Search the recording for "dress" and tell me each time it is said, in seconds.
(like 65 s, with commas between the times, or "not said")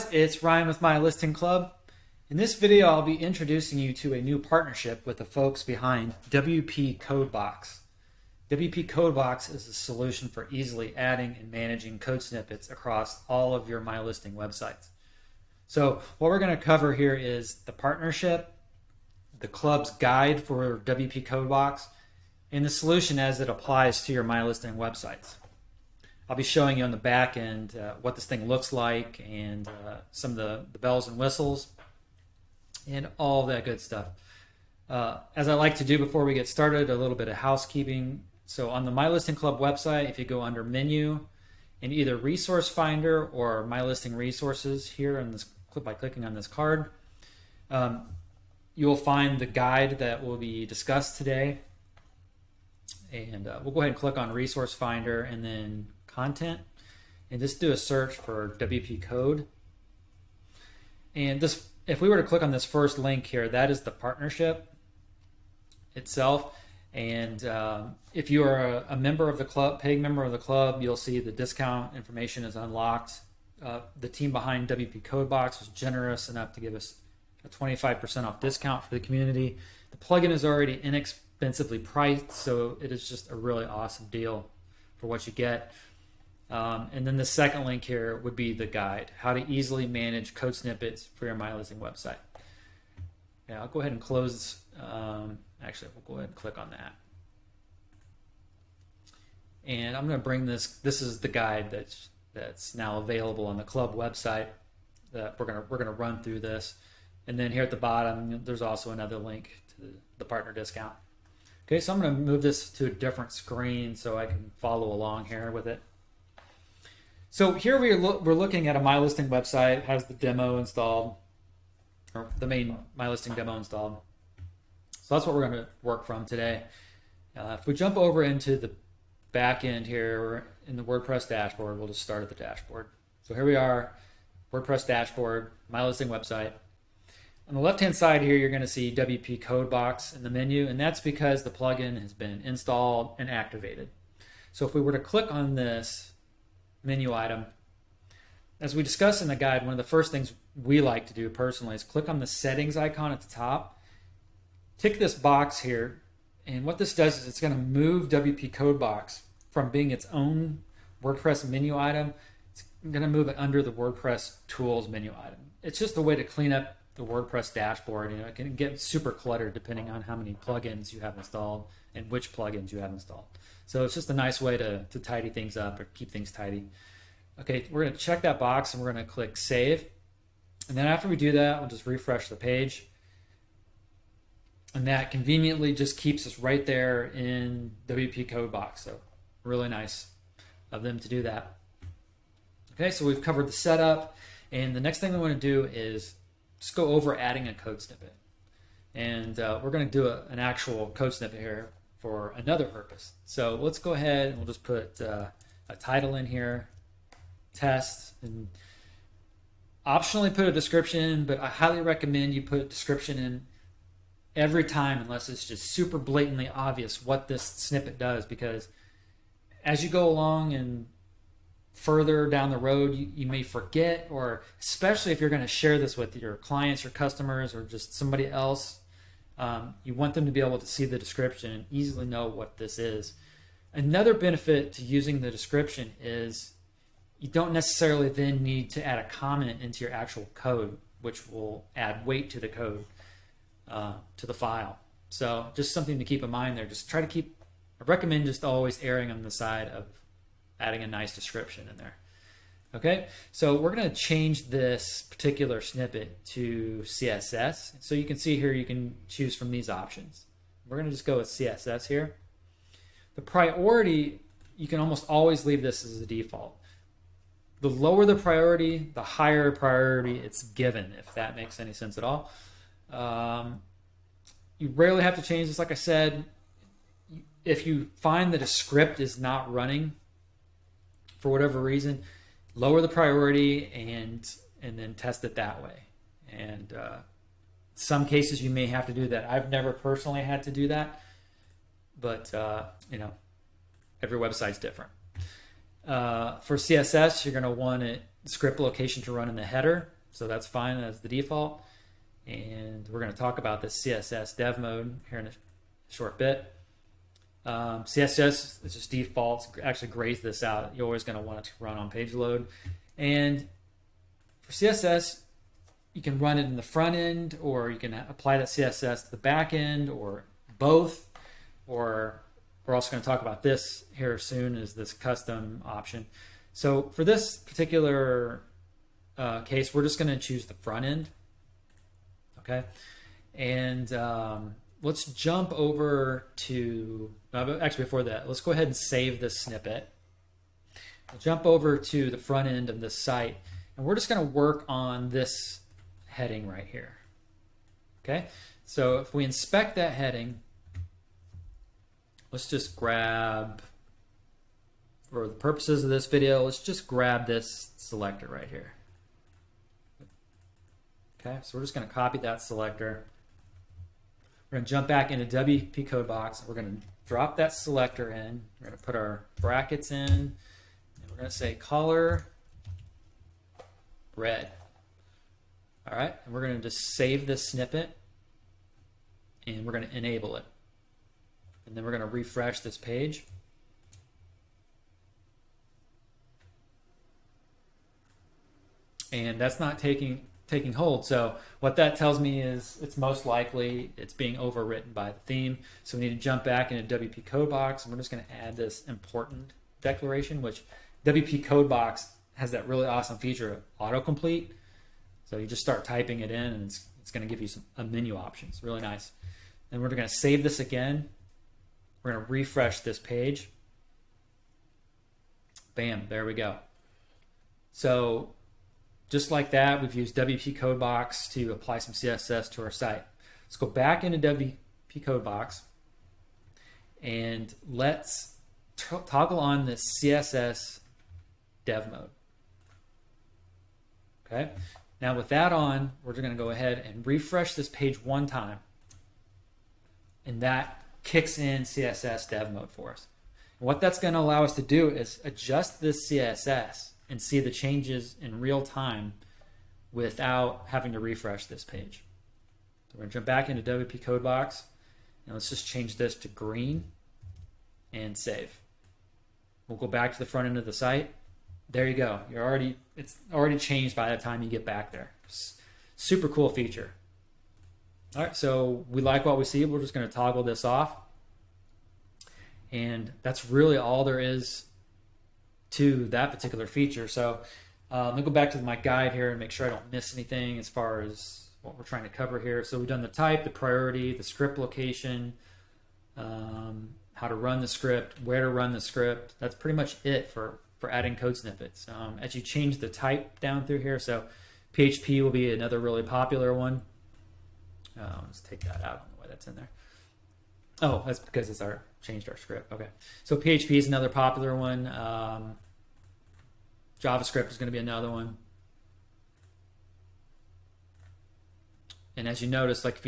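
not said.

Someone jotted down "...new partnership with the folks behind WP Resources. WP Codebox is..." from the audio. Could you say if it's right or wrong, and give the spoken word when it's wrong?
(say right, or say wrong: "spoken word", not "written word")
wrong: "Codebox", not "Resources".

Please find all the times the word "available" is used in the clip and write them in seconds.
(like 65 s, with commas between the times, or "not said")
102 s.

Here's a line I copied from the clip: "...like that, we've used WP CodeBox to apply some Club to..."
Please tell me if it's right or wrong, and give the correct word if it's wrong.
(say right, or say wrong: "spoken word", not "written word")
wrong: "CSS", not "Club".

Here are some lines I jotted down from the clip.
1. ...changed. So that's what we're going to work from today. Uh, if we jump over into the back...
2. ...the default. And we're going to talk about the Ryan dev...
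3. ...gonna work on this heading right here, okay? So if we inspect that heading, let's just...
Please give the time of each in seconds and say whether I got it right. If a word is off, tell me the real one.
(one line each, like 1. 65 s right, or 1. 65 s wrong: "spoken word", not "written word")
1. 123 s wrong: "installed", not "changed"
2. 301 s wrong: "CSS", not "Ryan"
3. 344 s right.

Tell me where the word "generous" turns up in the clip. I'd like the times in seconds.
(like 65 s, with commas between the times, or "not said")
75 s.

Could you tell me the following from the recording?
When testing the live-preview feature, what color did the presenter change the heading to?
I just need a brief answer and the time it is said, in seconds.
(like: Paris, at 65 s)
green, at 456 s.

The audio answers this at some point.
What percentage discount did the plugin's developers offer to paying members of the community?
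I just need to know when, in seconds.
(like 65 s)
77 s.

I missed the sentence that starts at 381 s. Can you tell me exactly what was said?
And then we're going to refresh this page.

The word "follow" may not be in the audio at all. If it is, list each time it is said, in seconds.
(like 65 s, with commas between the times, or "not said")
114 s.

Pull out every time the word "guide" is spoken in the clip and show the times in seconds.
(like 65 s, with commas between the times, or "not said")
19 s, 49 s, 88 s, 101 s, 149 s, 478 s.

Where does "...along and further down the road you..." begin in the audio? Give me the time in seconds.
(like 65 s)
220 s.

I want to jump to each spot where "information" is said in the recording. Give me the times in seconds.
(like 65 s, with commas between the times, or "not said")
71 s.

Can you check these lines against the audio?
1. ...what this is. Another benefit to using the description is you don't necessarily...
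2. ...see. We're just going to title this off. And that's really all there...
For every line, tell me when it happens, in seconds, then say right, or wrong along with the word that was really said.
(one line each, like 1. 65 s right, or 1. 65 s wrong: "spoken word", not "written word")
1. 232 s right
2. 469 s wrong: "toggle", not "title".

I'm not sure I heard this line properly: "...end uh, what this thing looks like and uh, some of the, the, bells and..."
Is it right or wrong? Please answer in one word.
right.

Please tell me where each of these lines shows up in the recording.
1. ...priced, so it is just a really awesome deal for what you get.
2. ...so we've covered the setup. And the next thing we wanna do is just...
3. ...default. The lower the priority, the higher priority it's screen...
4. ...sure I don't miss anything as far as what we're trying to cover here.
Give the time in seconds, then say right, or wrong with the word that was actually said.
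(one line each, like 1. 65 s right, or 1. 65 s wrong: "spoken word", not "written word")
1. 81 s right
2. 192 s right
3. 266 s wrong: "given", not "screen"
4. 479 s right.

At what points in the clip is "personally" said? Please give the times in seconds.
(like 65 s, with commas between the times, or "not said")
151 s, 289 s.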